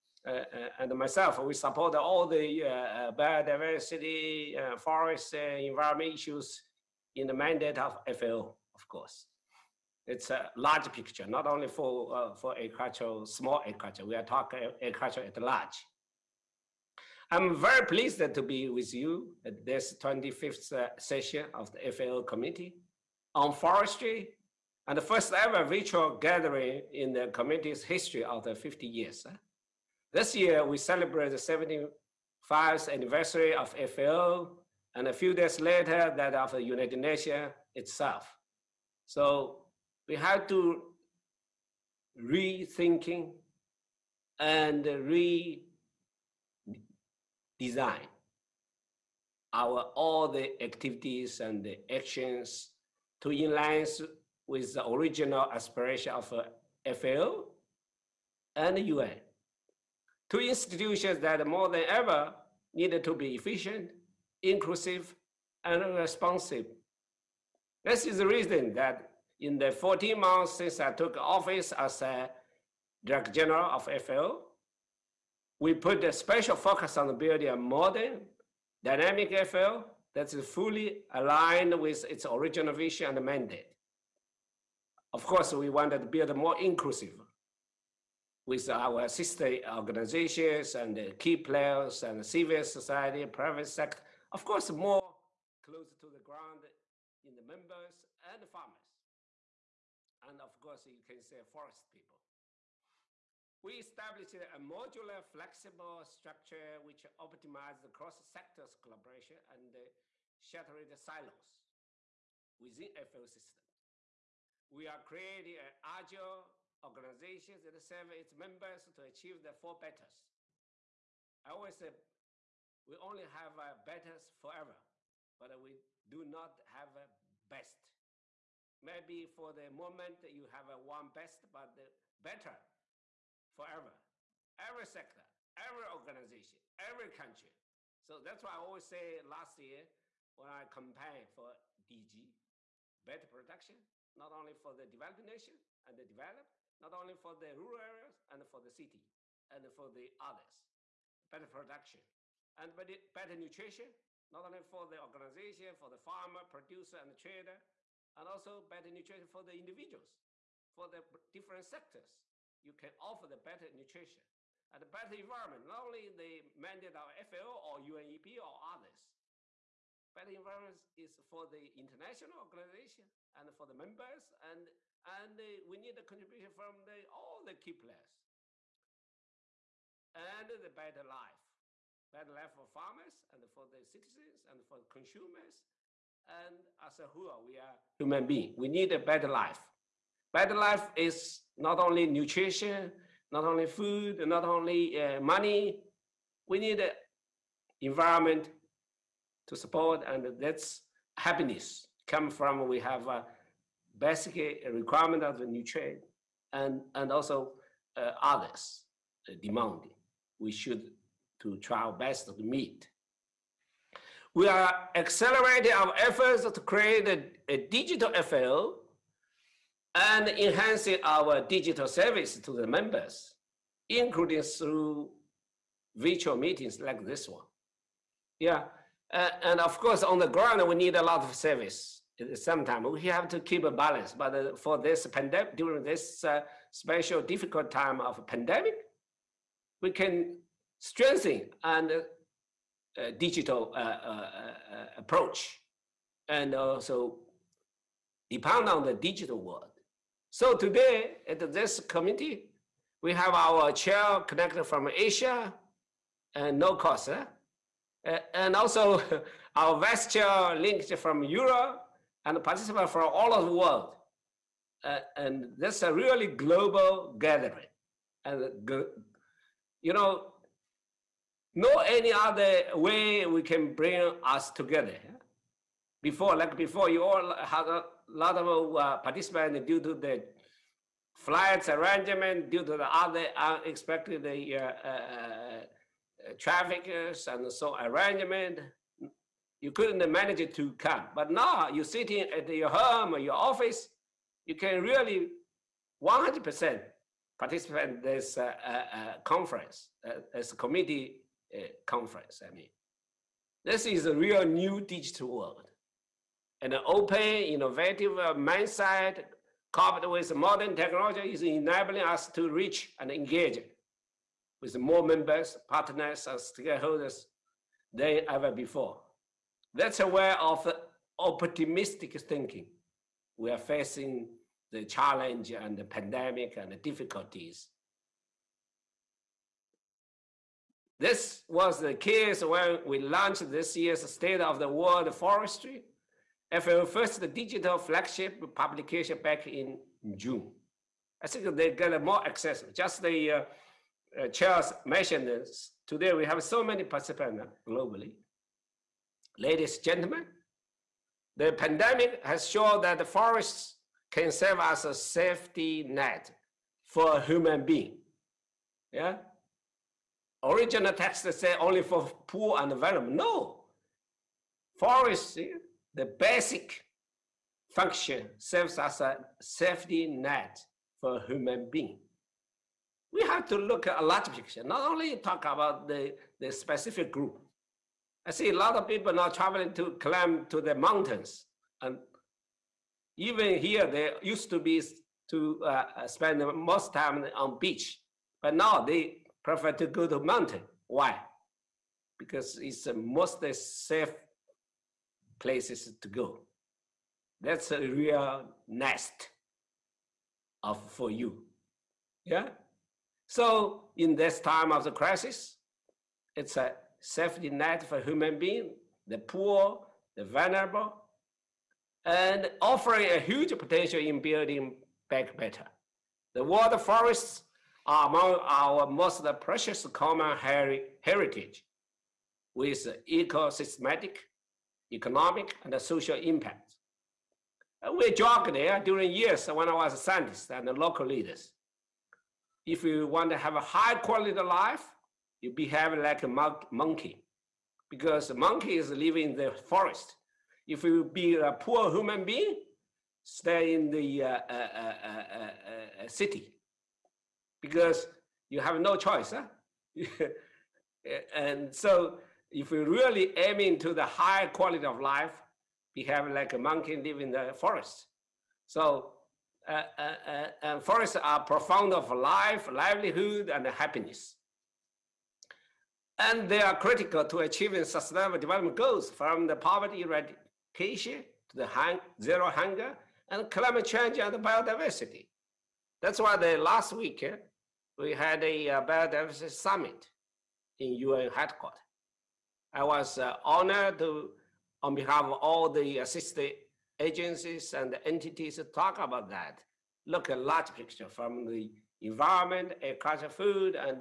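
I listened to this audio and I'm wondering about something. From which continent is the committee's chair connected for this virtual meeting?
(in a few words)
Asia.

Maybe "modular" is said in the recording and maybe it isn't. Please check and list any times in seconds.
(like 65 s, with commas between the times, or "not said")
104 s.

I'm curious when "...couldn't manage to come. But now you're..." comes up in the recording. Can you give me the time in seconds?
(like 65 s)
289 s.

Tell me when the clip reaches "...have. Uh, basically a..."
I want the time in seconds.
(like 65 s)
202 s.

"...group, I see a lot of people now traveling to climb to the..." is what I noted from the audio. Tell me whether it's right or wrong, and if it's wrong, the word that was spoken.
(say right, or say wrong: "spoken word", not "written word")
right.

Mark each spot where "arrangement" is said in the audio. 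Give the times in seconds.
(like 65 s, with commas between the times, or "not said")
281 s, 287 s.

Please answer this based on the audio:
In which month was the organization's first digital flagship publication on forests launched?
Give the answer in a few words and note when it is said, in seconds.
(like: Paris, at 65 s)
June, at 340 s.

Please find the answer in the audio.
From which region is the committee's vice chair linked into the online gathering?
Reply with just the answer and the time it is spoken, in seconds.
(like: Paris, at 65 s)
Europe, at 261 s.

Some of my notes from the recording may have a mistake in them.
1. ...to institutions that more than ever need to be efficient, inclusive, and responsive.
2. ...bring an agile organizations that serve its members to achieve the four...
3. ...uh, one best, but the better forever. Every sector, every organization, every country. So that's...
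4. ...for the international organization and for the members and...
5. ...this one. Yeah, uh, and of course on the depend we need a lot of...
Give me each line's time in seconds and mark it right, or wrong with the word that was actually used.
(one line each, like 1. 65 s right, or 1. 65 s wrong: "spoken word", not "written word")
1. 60 s right
2. 115 s wrong: "creating", not "bring"
3. 130 s right
4. 171 s right
5. 227 s wrong: "ground", not "depend".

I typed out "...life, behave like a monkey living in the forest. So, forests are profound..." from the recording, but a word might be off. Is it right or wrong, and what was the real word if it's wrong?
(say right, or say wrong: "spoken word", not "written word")
right.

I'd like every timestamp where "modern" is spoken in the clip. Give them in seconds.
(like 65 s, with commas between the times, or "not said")
77 s, 310 s.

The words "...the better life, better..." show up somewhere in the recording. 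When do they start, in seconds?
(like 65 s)
180 s.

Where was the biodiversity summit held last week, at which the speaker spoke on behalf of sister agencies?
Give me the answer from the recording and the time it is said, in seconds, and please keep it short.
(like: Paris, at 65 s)
UN headquarters, at 480 s.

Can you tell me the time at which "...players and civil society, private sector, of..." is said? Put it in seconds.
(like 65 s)
91 s.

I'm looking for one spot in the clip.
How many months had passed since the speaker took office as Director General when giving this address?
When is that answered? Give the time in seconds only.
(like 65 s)
69 s.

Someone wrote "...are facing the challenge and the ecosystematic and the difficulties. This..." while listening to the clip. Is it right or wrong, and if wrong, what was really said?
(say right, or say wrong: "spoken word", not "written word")
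wrong: "pandemic", not "ecosystematic".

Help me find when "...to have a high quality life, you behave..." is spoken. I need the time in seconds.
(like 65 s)
433 s.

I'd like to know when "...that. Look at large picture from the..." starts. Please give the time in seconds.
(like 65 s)
489 s.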